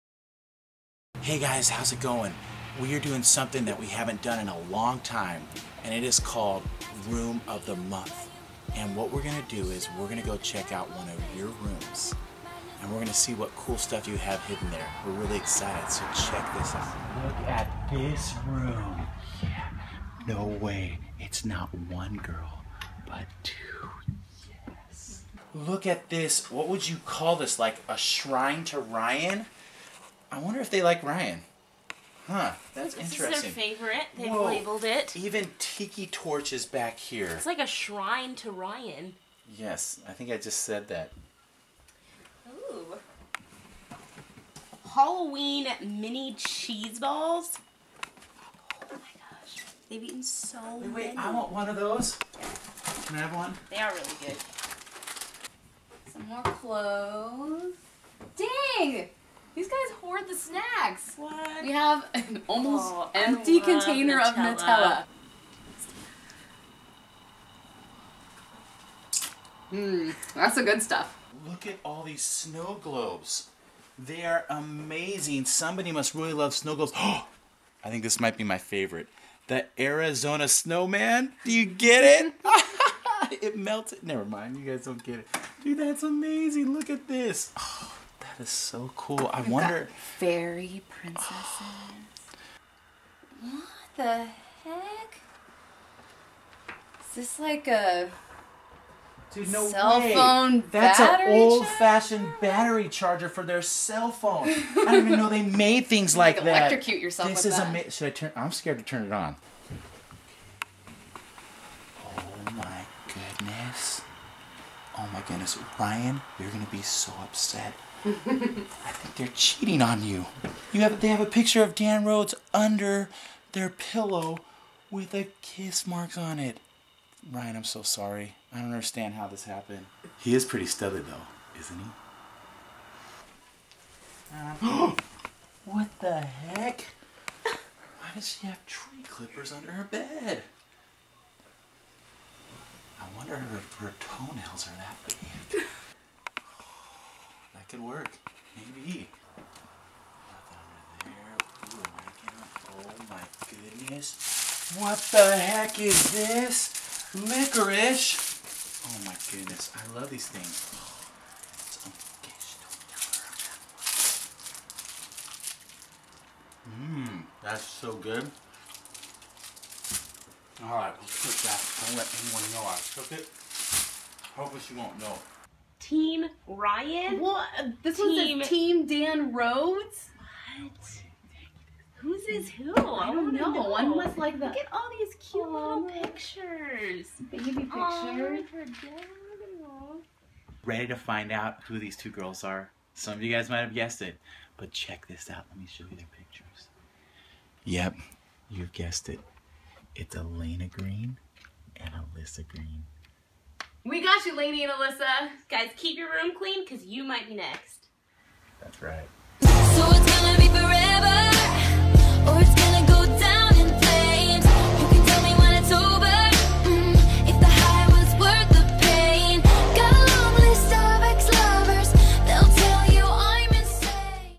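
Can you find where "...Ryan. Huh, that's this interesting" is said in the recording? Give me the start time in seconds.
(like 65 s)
31 s.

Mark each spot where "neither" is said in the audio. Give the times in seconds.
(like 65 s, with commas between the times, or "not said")
not said.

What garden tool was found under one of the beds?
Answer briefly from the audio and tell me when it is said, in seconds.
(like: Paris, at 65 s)
Tree clippers, at 138 s.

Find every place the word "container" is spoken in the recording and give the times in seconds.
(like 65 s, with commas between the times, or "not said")
63 s.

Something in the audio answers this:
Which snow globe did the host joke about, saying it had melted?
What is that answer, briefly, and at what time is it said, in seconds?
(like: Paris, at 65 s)
The Arizona snowman, at 79 s.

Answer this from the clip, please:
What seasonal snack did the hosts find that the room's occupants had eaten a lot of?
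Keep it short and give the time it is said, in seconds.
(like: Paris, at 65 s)
Halloween mini cheese balls, at 44 s.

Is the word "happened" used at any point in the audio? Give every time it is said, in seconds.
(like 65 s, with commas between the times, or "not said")
129 s.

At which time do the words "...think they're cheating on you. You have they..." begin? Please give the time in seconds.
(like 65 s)
118 s.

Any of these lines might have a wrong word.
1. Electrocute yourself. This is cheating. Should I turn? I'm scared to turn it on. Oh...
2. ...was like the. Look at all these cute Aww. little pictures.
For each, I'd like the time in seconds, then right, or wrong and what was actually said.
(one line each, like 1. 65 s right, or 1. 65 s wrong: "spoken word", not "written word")
1. 106 s wrong: "amazing", not "cheating"
2. 183 s right.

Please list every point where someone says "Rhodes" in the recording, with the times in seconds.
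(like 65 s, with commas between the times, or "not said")
122 s, 179 s.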